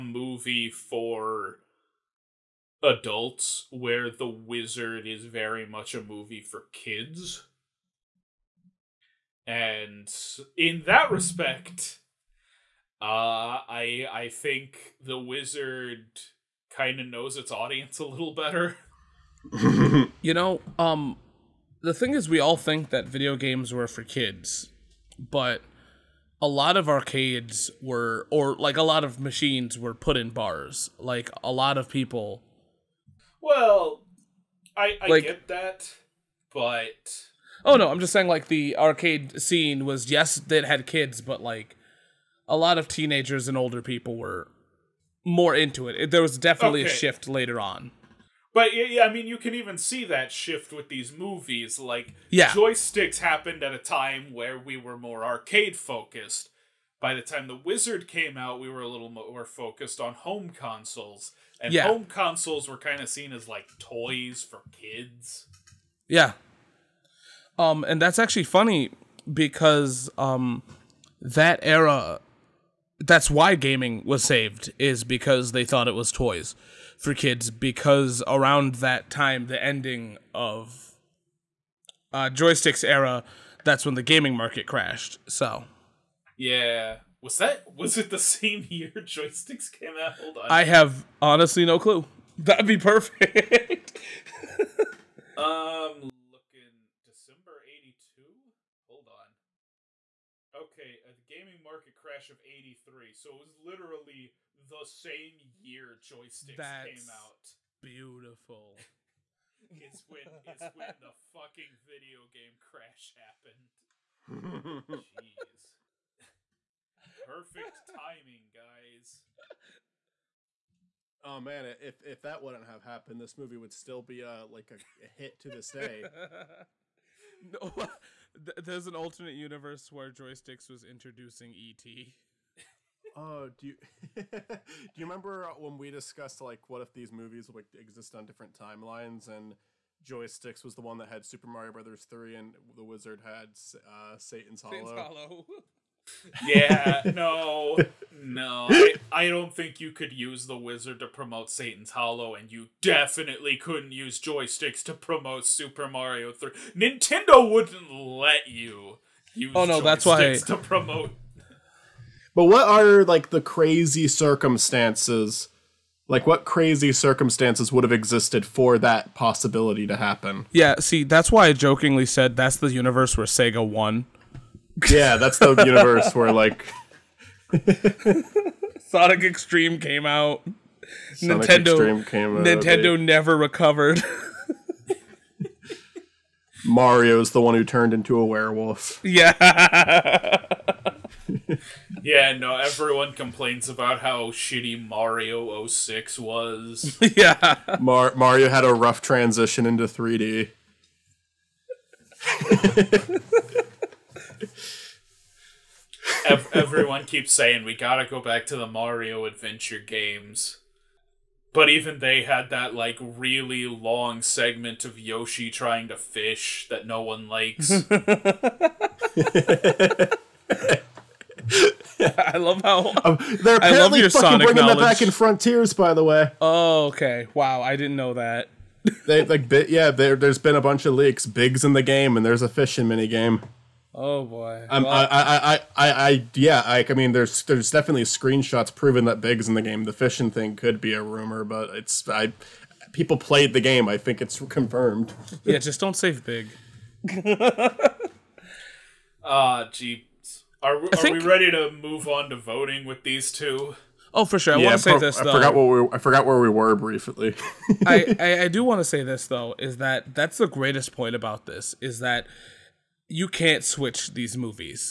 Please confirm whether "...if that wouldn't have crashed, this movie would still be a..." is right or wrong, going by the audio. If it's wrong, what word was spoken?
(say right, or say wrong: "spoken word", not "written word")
wrong: "happened", not "crashed".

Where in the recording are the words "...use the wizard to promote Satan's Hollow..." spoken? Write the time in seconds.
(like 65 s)
150 s.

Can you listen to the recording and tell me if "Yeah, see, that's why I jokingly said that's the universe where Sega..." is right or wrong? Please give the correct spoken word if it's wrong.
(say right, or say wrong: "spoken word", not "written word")
right.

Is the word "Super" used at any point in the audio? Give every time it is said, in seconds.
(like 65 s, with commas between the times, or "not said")
141 s, 155 s.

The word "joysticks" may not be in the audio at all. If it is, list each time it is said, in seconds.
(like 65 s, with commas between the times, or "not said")
52 s, 82 s, 88 s, 105 s, 130 s, 140 s, 154 s.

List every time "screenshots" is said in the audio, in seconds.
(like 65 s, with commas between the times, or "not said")
238 s.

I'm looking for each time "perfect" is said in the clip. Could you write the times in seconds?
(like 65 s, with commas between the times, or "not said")
92 s, 117 s.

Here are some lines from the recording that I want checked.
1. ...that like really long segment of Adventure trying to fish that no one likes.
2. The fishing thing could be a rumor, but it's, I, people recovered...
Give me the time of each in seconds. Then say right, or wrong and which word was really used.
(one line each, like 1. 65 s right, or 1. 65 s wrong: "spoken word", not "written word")
1. 212 s wrong: "Yoshi", not "Adventure"
2. 239 s wrong: "played", not "recovered".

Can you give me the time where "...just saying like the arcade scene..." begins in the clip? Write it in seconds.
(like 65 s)
38 s.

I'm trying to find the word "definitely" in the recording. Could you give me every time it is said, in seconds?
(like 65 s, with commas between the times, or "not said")
46 s, 152 s, 237 s.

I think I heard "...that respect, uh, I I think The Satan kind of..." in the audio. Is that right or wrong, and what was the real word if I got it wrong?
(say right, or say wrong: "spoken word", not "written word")
wrong: "Wizard", not "Satan".